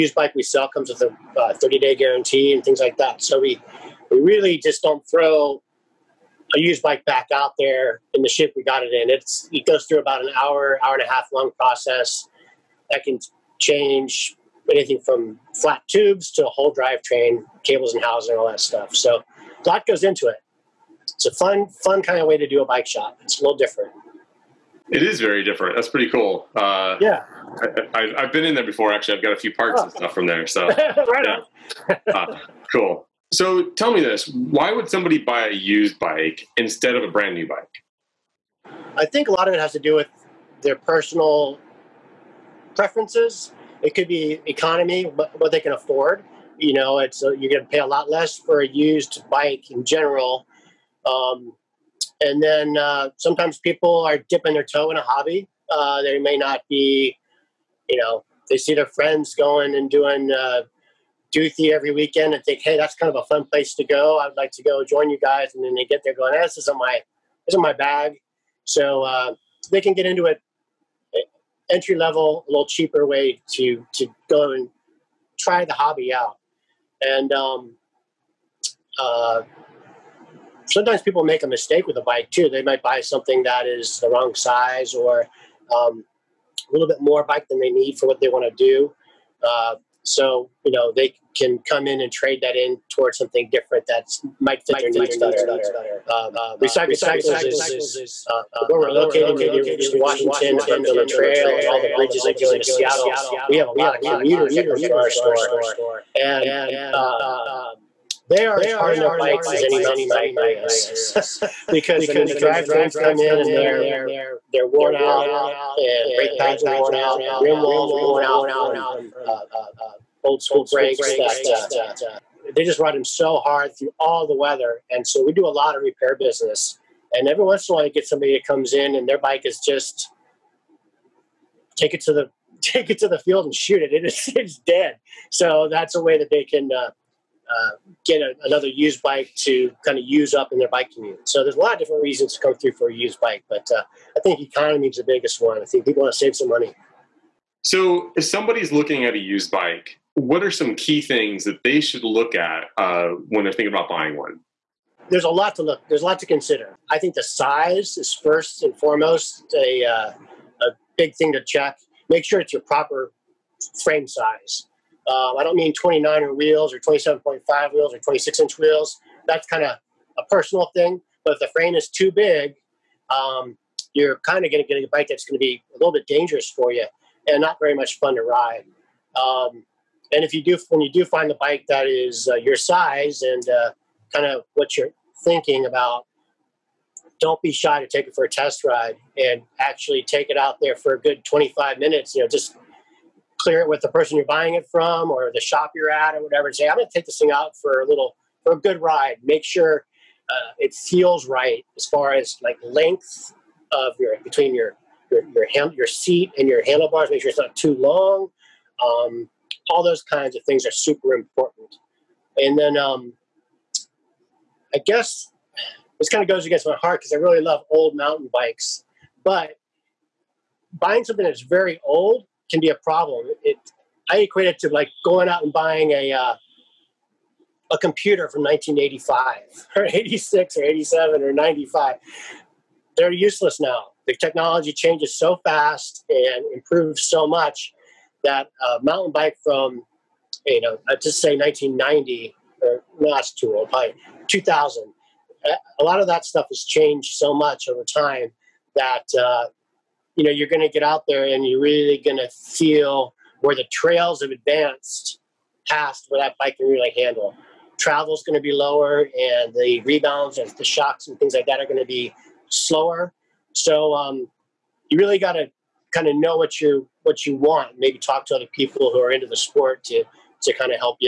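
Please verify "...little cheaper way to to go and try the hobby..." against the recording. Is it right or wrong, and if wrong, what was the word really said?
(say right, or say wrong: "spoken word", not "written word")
right.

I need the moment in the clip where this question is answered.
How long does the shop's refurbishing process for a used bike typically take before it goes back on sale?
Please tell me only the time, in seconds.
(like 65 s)
9 s.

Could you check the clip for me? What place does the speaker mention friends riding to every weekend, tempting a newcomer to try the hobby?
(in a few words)
Duthie.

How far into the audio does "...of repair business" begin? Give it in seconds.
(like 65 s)
125 s.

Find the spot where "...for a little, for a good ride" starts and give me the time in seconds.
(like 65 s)
197 s.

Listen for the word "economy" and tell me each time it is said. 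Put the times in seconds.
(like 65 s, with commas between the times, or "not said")
44 s, 144 s.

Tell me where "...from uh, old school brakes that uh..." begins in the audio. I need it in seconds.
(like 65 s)
118 s.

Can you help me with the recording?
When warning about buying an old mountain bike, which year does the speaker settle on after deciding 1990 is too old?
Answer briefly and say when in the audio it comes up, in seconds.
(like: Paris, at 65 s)
2000, at 244 s.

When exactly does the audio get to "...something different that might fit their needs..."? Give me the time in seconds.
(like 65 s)
93 s.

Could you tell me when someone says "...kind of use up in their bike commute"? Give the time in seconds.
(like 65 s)
139 s.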